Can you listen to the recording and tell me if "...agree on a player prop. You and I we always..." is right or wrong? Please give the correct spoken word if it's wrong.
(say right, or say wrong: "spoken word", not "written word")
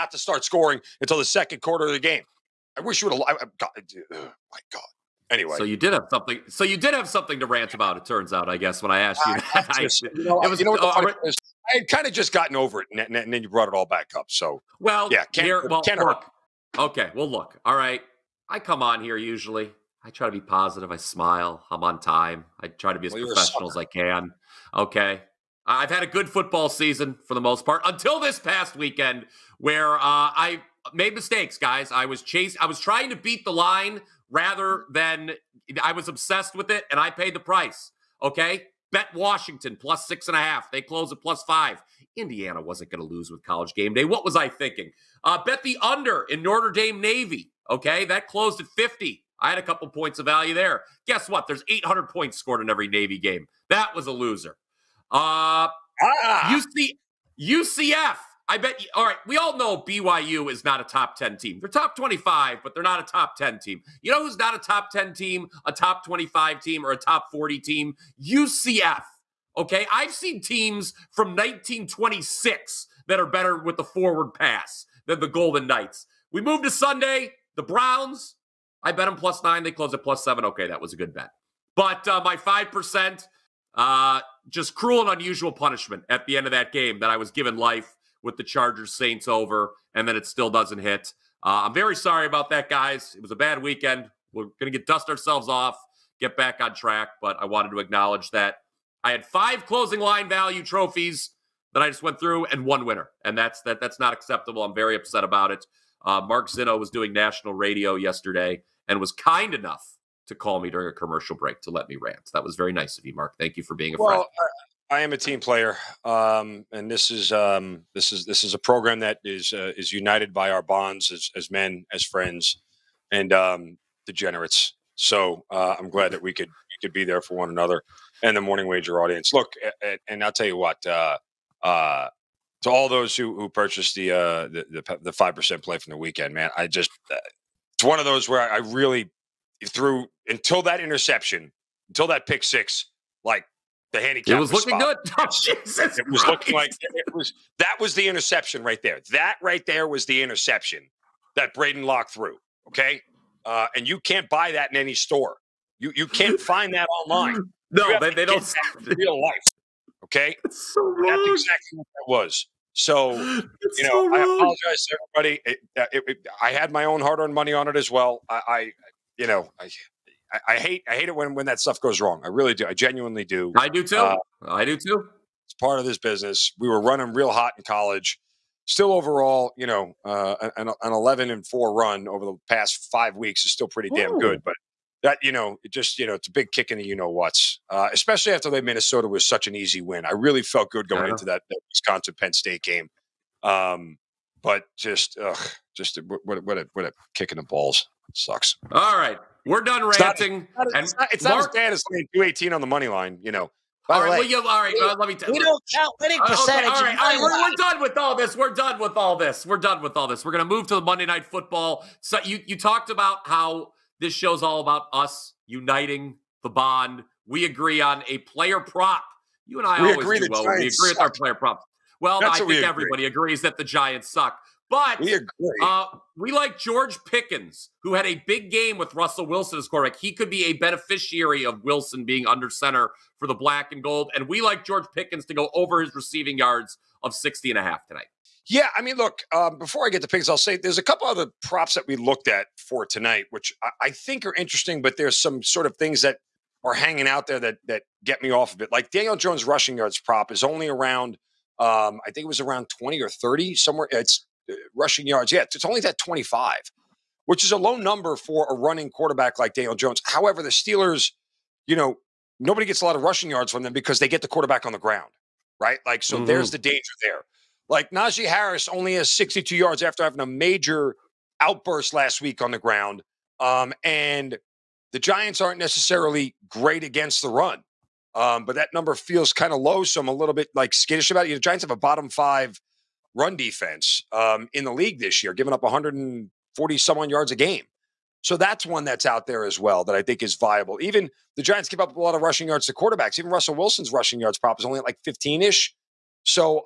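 right.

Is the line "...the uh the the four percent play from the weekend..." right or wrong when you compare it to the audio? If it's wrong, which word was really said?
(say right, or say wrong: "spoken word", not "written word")
wrong: "five", not "four".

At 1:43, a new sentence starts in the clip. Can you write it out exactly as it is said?
And that's that that's not acceptable.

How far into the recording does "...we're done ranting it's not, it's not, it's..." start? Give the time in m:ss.
3:19.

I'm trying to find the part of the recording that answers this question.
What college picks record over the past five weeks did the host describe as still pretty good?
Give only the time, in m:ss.
3:00.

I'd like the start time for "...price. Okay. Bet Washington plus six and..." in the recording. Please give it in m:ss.
0:37.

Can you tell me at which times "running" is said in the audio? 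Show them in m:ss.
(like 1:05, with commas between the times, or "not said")
2:56, 4:18.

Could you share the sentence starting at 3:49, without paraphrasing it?
He could be a beneficiary of Wilson being under center for the black and gold.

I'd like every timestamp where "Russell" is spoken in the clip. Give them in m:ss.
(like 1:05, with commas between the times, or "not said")
3:48, 4:53.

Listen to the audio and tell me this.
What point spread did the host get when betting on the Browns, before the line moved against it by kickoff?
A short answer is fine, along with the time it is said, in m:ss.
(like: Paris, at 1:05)
+9, at 1:19.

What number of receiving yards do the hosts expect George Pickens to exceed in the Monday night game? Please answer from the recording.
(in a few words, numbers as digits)
60.5.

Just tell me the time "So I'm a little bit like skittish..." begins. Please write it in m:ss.
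4:39.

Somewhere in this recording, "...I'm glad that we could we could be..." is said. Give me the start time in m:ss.
2:05.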